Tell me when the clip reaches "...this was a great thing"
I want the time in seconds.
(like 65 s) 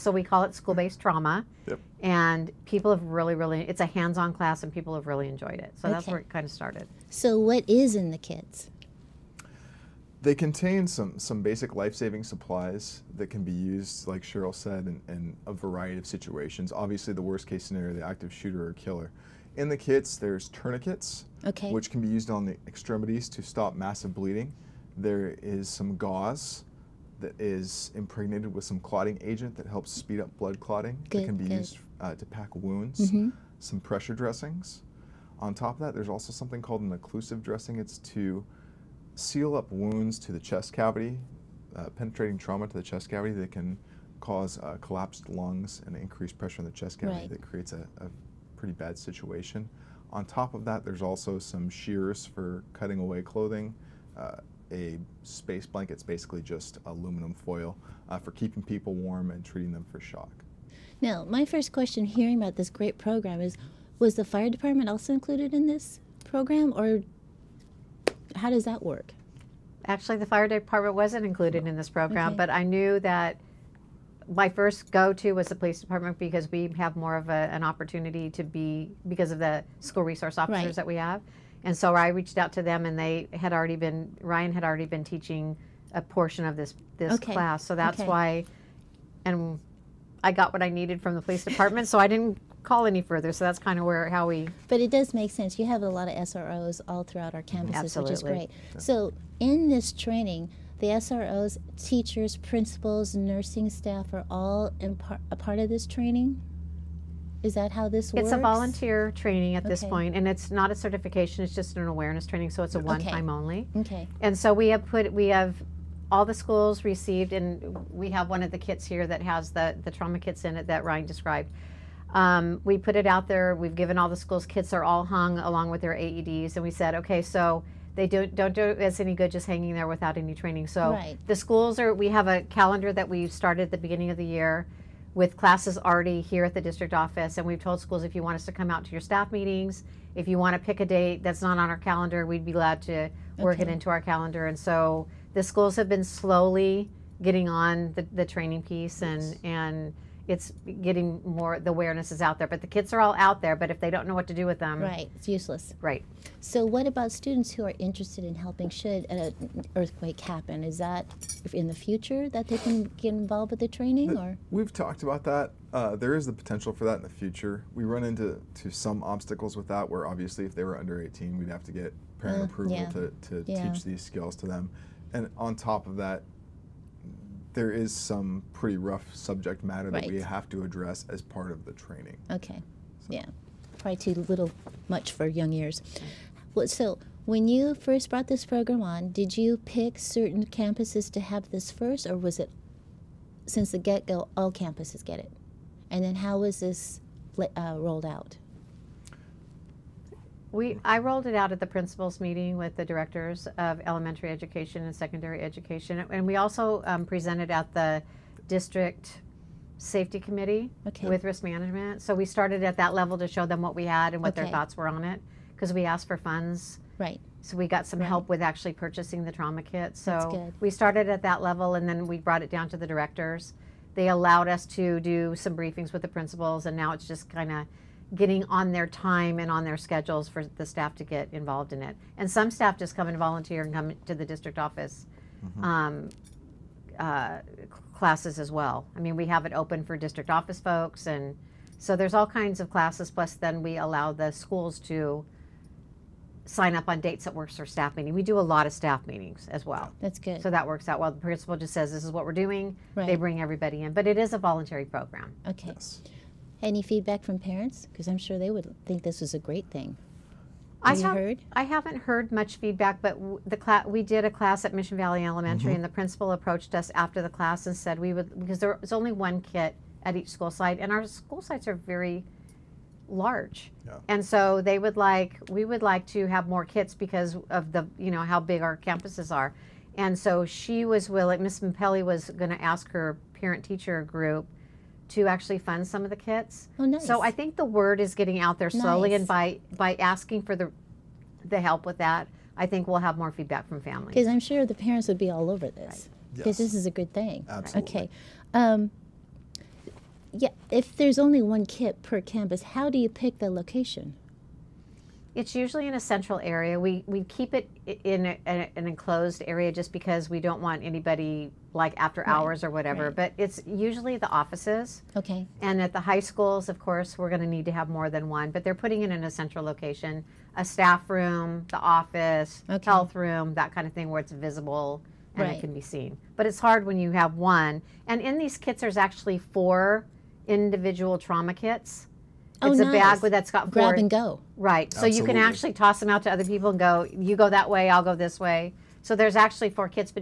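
259 s.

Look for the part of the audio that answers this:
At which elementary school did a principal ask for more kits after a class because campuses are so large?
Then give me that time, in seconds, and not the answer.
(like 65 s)
264 s.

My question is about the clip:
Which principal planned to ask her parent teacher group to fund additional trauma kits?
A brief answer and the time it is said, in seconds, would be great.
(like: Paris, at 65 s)
Miss Mapelli, at 281 s.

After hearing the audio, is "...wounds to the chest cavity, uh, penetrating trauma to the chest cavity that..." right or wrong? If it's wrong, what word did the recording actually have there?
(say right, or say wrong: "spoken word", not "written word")
right.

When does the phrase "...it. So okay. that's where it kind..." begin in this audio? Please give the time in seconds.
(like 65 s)
5 s.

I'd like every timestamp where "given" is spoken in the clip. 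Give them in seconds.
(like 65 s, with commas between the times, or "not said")
123 s.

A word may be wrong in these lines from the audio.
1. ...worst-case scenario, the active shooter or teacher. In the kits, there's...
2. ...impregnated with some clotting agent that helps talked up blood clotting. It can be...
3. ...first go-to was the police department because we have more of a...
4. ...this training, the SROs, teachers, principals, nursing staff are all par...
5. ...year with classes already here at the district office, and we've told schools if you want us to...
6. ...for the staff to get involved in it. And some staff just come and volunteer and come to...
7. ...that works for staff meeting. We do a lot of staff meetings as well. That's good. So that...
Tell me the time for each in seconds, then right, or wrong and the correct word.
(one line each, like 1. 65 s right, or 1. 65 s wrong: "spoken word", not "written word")
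1. 17 s wrong: "killer", not "teacher"
2. 27 s wrong: "speed", not "talked"
3. 74 s right
4. 99 s right
5. 134 s right
6. 230 s right
7. 247 s right.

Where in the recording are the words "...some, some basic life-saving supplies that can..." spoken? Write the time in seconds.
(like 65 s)
10 s.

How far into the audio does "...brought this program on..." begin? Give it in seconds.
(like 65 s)
188 s.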